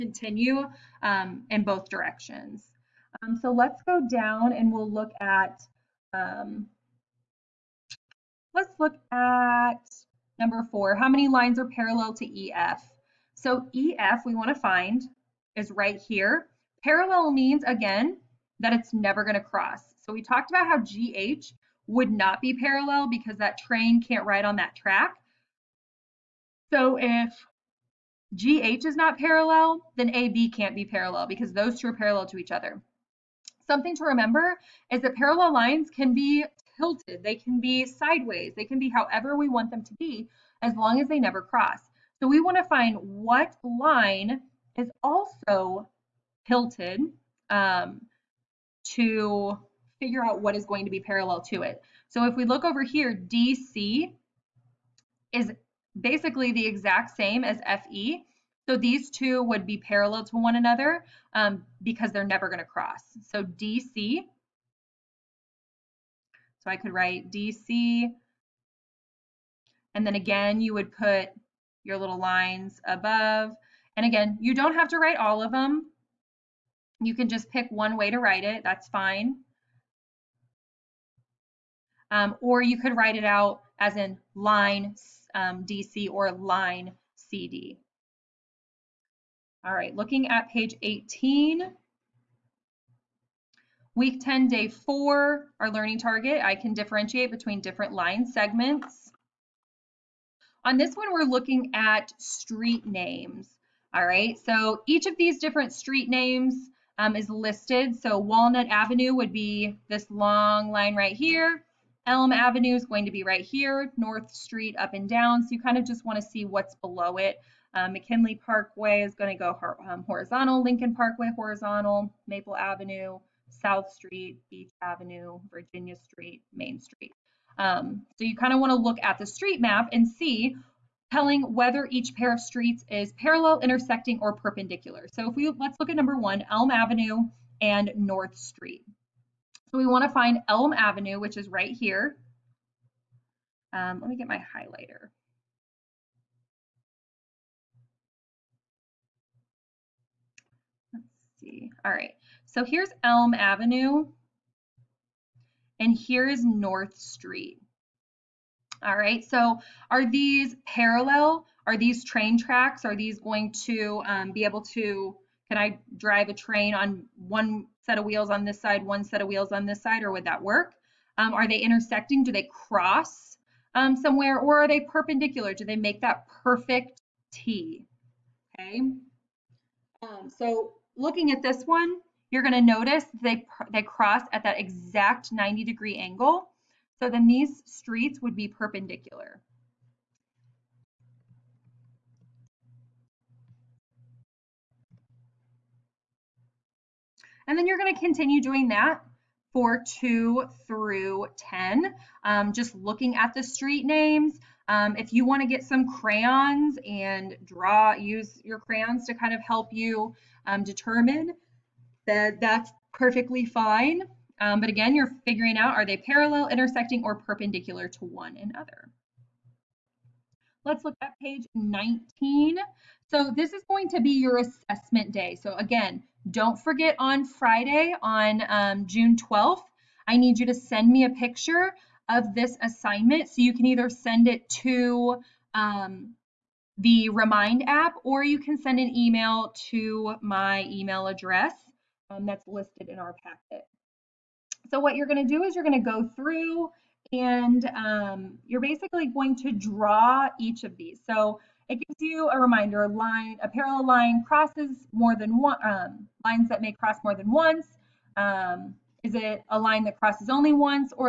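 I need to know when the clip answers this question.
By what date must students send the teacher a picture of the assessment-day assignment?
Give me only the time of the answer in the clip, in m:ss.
3:48.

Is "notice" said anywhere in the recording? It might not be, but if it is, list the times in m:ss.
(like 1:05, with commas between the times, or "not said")
3:02.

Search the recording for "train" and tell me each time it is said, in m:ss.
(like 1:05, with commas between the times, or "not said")
0:23, 2:42, 2:46.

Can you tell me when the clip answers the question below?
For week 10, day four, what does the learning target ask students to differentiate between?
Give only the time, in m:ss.
1:37.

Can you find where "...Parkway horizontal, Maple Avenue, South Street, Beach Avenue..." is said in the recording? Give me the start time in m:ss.
2:00.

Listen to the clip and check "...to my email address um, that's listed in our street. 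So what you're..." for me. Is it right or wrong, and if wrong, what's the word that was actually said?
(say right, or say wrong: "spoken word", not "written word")
wrong: "packet", not "street".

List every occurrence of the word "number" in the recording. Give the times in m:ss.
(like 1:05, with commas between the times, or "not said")
0:10, 2:15.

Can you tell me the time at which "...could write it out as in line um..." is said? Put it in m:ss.
1:22.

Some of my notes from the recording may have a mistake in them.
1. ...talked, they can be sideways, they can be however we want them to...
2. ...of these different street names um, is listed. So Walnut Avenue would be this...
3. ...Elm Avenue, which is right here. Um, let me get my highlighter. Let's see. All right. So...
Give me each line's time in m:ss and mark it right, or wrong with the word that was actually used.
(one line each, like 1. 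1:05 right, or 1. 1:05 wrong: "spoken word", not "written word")
1. 0:36 wrong: "tilted", not "talked"
2. 1:45 right
3. 2:20 right.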